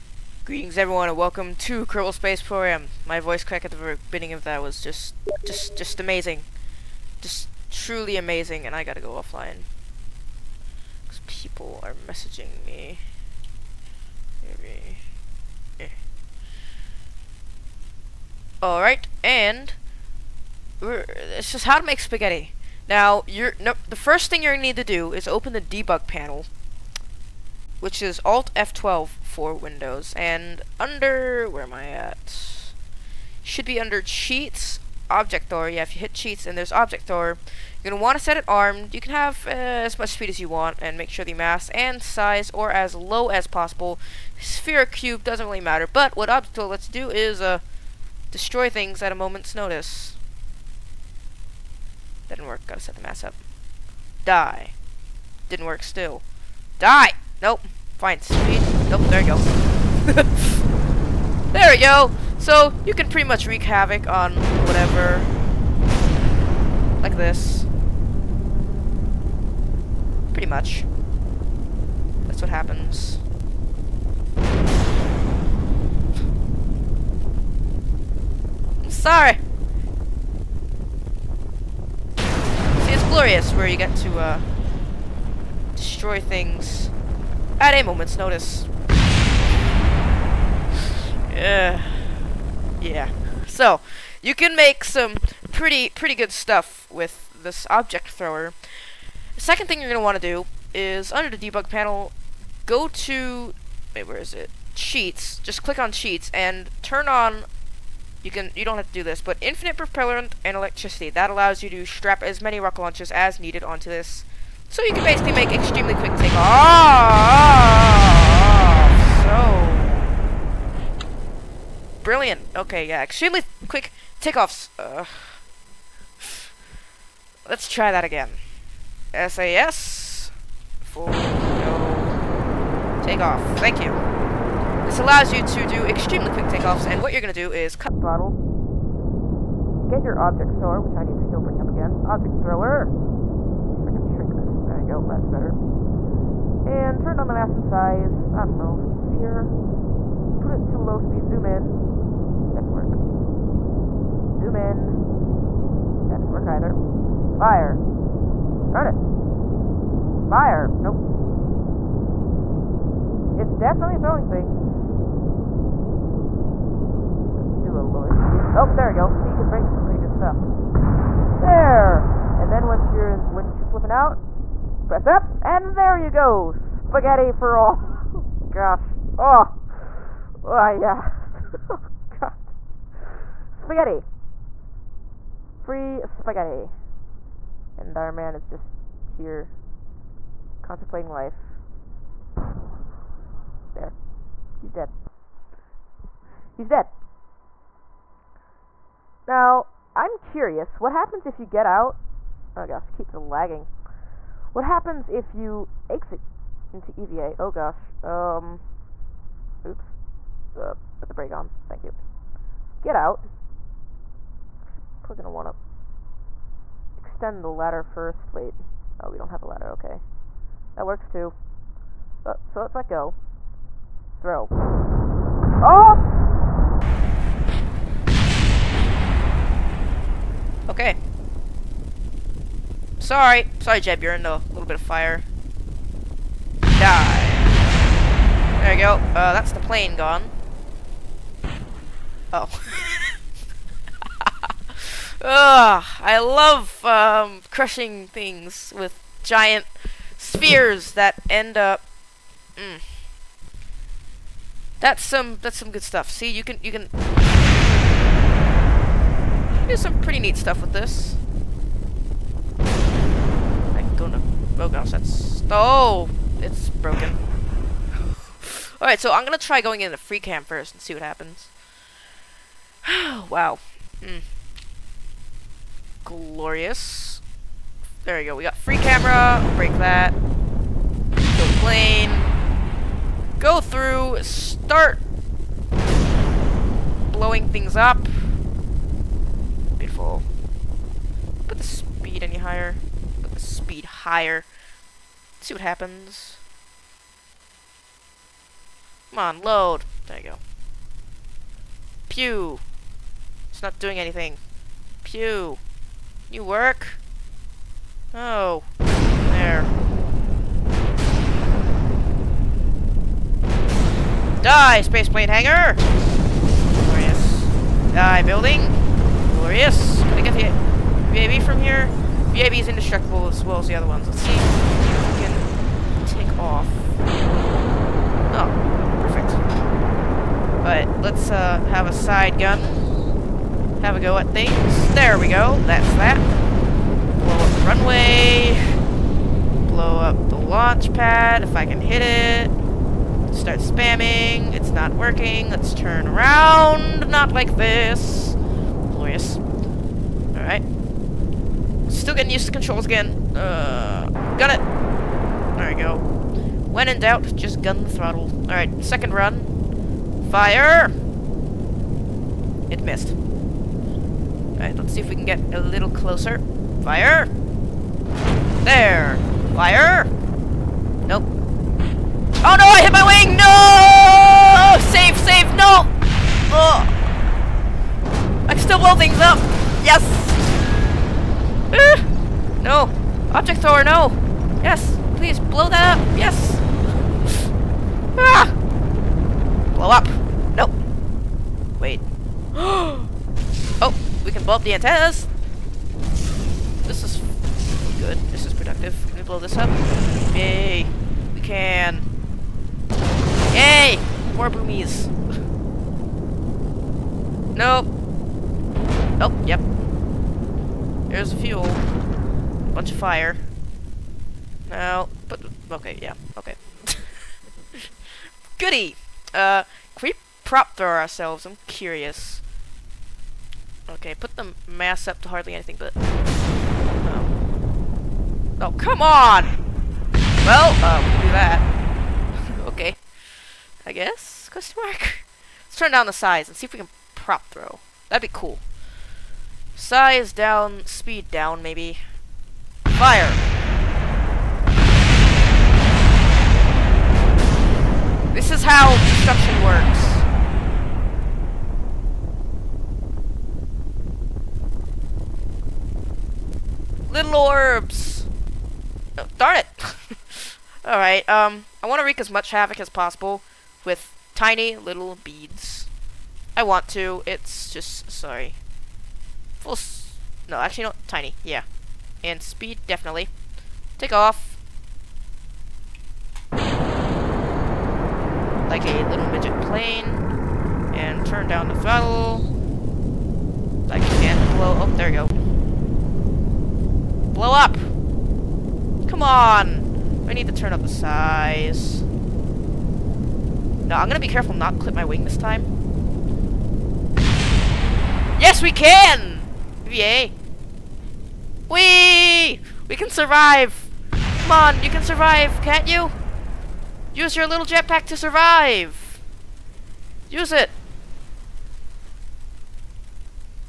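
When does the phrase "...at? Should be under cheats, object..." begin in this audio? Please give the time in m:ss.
0:31.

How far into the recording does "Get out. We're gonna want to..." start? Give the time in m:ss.
3:32.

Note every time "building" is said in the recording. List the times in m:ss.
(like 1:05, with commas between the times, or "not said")
5:18.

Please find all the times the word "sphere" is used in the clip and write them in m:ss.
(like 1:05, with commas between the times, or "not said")
0:44, 2:28, 4:10.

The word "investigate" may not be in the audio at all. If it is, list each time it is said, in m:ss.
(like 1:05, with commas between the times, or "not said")
not said.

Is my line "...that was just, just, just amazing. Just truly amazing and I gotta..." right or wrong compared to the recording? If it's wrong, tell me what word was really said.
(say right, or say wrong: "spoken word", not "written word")
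right.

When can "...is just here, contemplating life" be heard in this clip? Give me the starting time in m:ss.
3:08.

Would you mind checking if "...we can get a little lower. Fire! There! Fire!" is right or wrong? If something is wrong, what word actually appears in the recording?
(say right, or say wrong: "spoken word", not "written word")
wrong: "closer", not "lower".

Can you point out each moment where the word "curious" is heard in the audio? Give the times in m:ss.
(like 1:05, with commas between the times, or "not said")
3:20, 7:01.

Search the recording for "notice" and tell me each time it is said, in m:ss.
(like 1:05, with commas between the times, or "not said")
0:49, 1:28.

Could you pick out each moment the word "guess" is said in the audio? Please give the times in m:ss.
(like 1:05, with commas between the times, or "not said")
7:13.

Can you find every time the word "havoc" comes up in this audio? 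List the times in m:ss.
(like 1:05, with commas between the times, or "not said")
1:03, 7:42.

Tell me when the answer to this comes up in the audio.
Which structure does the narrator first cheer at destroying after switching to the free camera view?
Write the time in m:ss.
5:14.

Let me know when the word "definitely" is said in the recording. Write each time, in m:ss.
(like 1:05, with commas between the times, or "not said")
2:43, 7:52.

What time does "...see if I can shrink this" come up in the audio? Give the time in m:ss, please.
2:23.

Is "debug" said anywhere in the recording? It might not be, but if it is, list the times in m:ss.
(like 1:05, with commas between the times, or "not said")
0:25, 1:41.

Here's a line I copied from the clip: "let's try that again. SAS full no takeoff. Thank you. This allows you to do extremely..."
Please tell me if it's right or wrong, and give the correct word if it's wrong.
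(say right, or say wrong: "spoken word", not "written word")
right.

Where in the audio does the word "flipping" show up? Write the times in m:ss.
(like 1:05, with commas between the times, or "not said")
2:53.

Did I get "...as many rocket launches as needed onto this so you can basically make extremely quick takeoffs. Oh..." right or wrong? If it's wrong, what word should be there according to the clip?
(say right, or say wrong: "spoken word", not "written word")
right.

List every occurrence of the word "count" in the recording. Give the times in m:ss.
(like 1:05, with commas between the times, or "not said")
not said.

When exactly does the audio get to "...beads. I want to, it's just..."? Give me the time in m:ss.
7:45.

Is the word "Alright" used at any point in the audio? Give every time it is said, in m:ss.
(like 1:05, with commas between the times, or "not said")
0:18, 4:28, 5:49, 5:58, 6:03, 7:40.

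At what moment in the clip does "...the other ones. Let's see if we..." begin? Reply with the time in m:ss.
5:23.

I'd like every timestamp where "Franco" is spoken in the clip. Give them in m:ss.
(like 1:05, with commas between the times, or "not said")
not said.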